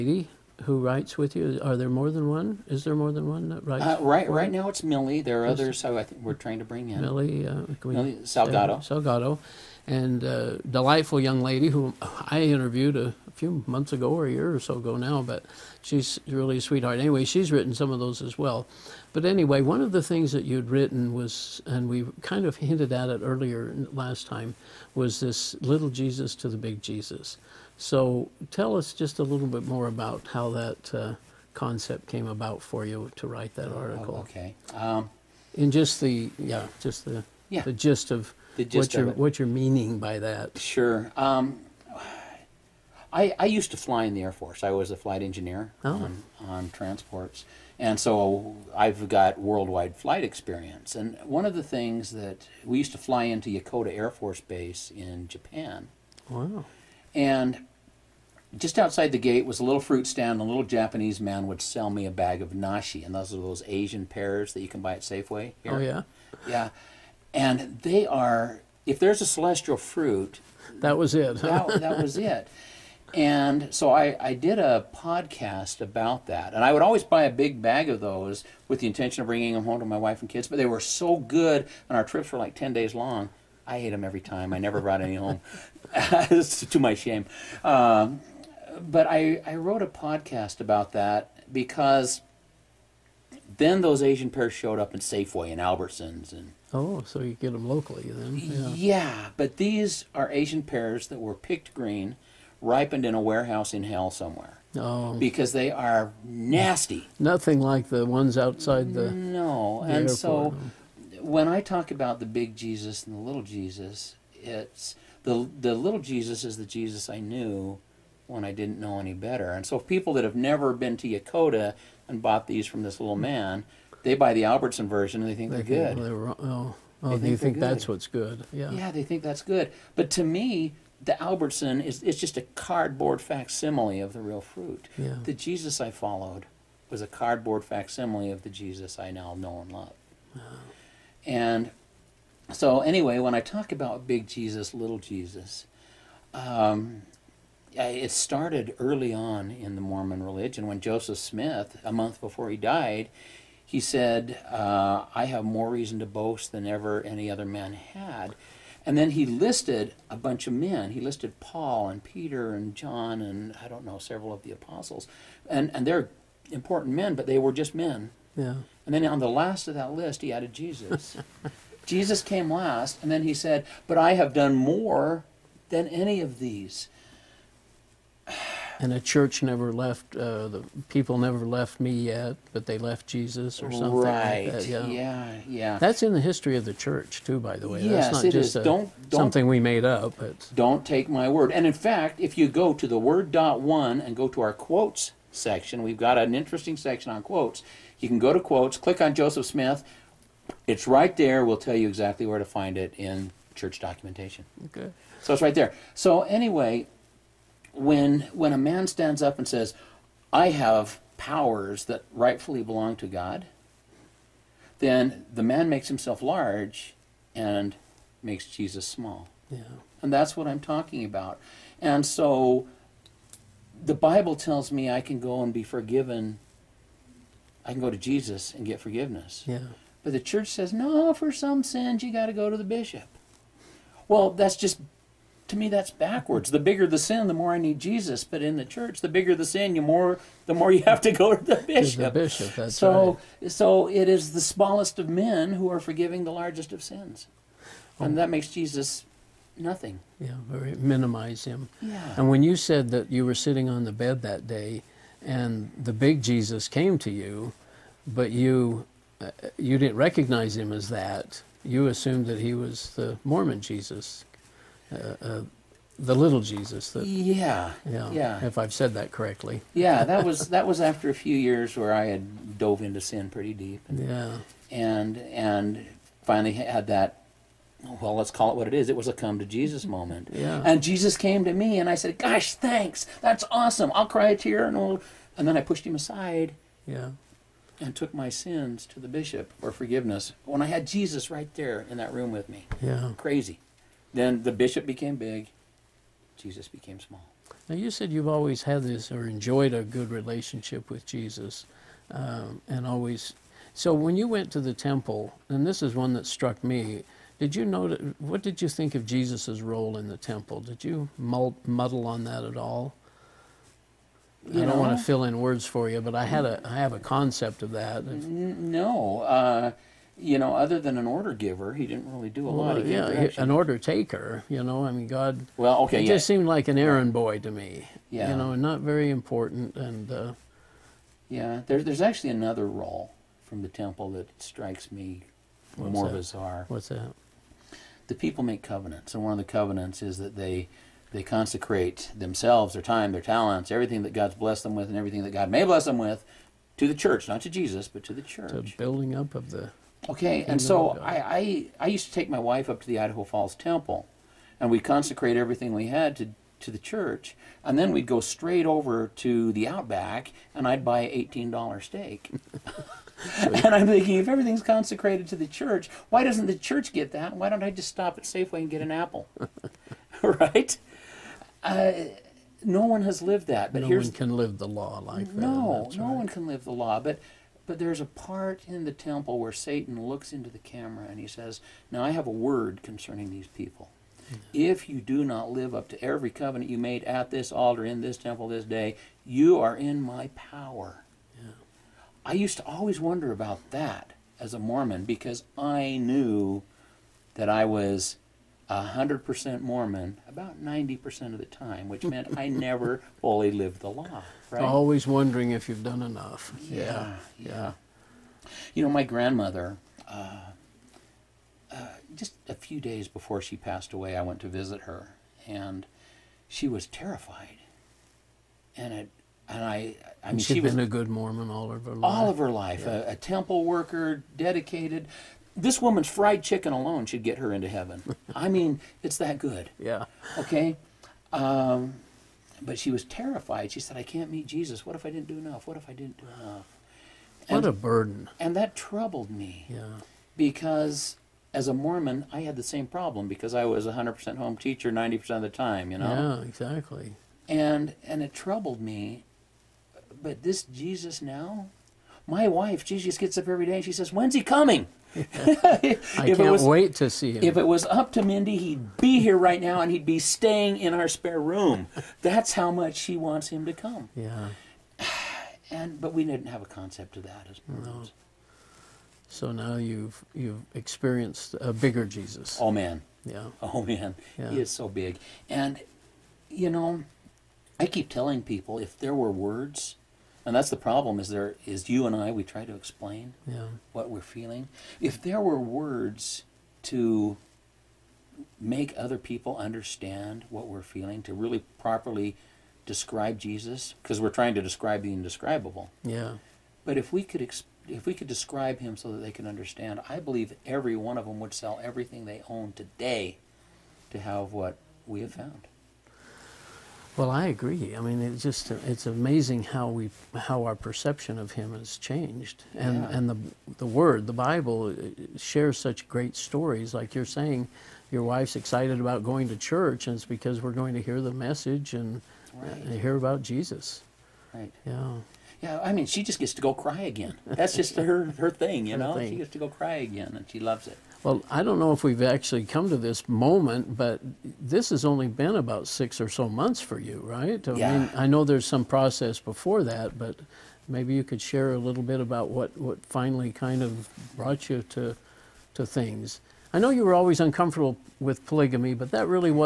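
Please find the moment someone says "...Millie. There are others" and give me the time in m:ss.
0:04.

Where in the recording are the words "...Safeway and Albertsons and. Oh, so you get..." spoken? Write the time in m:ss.
1:34.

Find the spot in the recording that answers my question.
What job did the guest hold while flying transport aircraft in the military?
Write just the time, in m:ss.
0:44.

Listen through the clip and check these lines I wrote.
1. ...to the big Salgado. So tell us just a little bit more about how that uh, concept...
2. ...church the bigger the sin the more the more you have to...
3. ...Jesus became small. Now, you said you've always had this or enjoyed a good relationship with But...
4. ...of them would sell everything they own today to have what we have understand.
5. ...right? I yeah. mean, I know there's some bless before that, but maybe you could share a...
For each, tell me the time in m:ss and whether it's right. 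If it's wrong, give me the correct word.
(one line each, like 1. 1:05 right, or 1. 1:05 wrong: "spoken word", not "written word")
1. 0:26 wrong: "Jesus", not "Salgado"
2. 3:58 right
3. 4:56 wrong: "Jesus", not "But"
4. 8:21 wrong: "found", not "understand"
5. 8:57 wrong: "process", not "bless".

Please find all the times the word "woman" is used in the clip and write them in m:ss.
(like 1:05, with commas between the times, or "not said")
7:05.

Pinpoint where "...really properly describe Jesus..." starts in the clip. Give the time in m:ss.
8:11.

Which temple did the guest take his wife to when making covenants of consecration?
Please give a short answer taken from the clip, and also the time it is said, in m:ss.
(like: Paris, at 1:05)
Idaho Falls Temple, at 5:52.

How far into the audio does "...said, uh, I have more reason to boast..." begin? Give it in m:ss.
2:33.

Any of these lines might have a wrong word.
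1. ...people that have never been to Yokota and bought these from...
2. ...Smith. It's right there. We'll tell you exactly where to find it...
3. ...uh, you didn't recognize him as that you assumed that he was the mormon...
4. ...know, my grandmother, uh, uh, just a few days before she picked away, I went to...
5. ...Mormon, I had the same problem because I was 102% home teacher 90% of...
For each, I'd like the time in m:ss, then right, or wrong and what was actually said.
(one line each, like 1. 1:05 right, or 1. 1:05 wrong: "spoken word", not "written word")
1. 1:59 right
2. 3:19 right
3. 4:19 right
4. 6:48 wrong: "passed", not "picked"
5. 7:21 wrong: "100", not "102".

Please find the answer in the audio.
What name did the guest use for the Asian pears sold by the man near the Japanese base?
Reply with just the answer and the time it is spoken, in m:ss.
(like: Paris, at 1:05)
Nashi, at 1:02.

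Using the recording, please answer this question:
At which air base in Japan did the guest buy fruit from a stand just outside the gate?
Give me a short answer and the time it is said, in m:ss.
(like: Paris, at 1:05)
Yokota Air Force Base, at 0:53.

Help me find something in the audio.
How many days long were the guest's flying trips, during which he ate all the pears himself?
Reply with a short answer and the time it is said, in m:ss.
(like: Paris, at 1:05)
10 days, at 1:22.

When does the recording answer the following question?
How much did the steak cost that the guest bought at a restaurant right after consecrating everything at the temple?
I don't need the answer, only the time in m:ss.
6:01.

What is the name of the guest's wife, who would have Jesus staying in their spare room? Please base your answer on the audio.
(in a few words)
Mindy.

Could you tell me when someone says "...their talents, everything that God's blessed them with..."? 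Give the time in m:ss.
5:43.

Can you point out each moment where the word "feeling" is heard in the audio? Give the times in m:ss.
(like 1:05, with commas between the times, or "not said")
8:04, 8:10.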